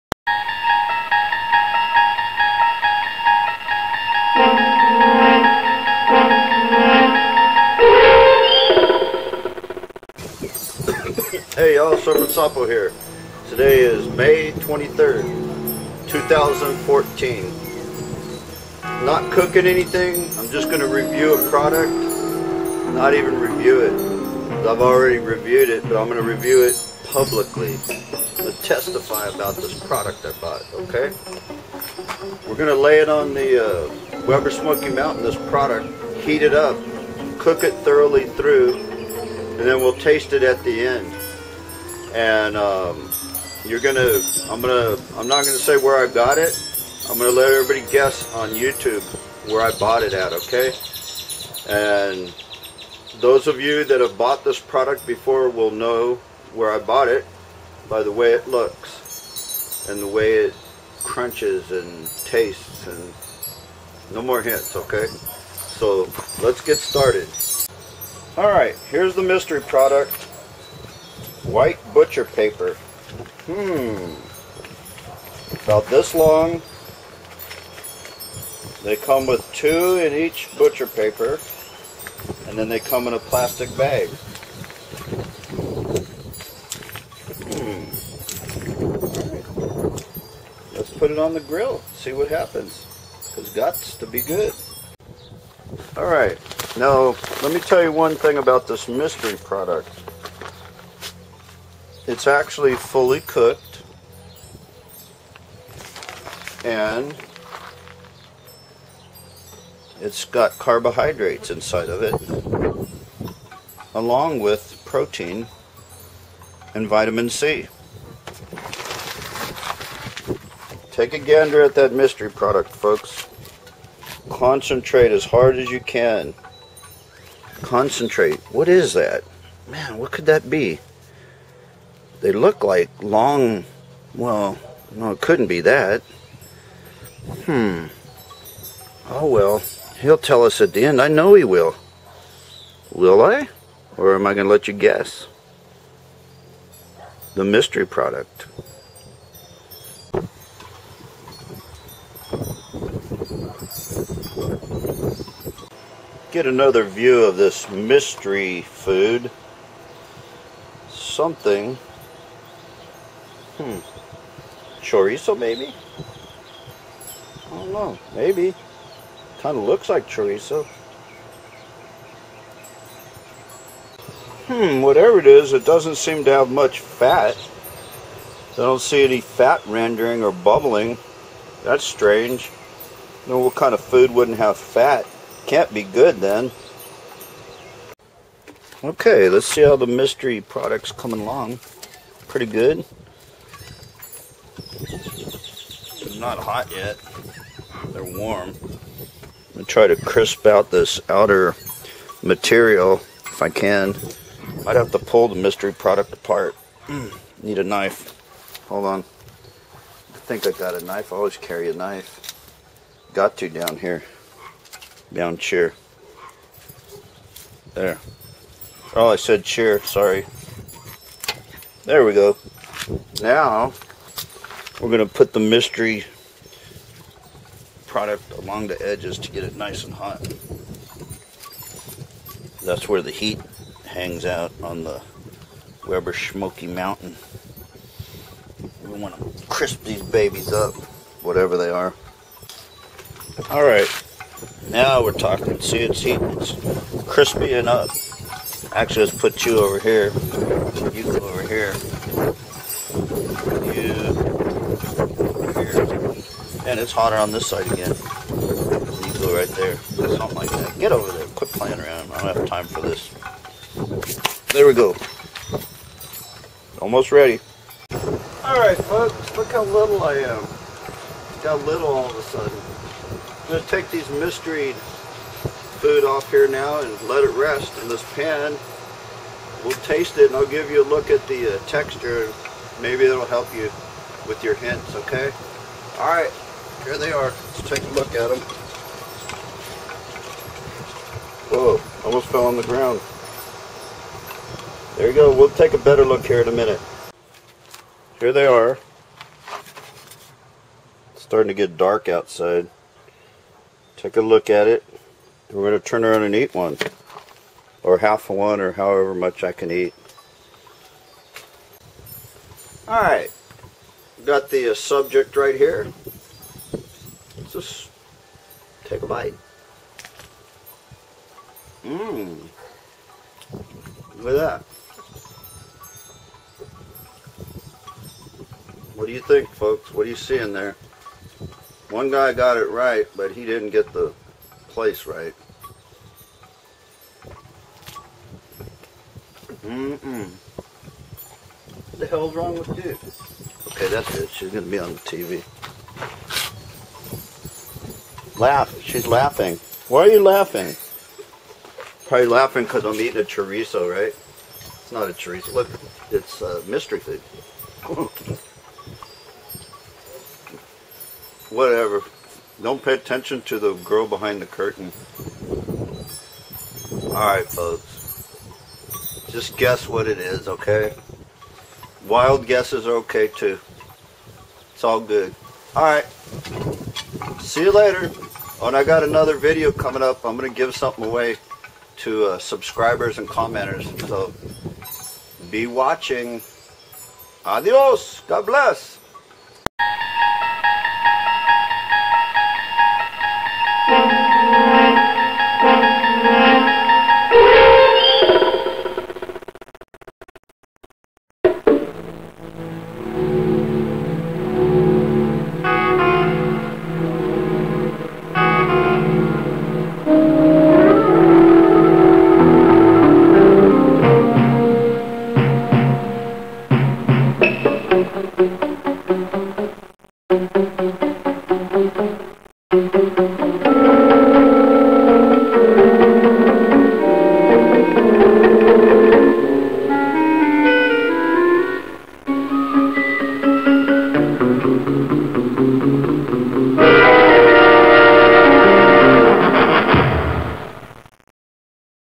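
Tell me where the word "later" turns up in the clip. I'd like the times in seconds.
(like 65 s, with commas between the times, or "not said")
377 s.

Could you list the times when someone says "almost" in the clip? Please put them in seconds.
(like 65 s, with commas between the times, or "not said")
266 s, 292 s.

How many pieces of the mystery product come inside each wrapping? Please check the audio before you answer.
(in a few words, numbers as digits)
2.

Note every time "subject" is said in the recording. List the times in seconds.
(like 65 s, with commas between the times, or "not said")
314 s.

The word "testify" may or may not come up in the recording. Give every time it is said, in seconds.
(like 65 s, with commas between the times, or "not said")
28 s.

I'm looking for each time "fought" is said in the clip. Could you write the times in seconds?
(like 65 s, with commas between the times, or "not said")
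not said.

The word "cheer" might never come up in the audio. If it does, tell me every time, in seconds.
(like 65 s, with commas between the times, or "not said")
215 s, 219 s.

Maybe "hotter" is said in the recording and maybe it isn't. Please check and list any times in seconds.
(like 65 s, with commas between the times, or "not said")
256 s.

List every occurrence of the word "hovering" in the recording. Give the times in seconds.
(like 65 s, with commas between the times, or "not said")
not said.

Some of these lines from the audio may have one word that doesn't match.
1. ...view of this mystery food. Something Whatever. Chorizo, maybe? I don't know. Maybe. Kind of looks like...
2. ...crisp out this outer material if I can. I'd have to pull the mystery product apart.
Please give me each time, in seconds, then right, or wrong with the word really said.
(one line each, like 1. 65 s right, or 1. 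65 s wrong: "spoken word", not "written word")
1. 156 s wrong: "Hmm", not "Whatever"
2. 199 s right.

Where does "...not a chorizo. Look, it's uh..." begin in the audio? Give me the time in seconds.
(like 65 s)
354 s.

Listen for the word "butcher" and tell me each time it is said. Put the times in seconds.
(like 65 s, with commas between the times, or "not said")
71 s, 80 s.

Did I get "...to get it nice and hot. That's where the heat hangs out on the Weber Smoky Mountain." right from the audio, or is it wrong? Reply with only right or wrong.
right.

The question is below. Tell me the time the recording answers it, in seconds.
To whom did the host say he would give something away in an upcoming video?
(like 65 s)
382 s.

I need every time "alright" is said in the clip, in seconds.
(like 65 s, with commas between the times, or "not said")
68 s, 95 s, 268 s, 285 s, 312 s, 367 s, 375 s.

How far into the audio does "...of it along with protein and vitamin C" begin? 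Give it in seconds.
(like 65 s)
111 s.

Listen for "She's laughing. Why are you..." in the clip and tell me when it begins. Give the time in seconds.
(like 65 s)
348 s.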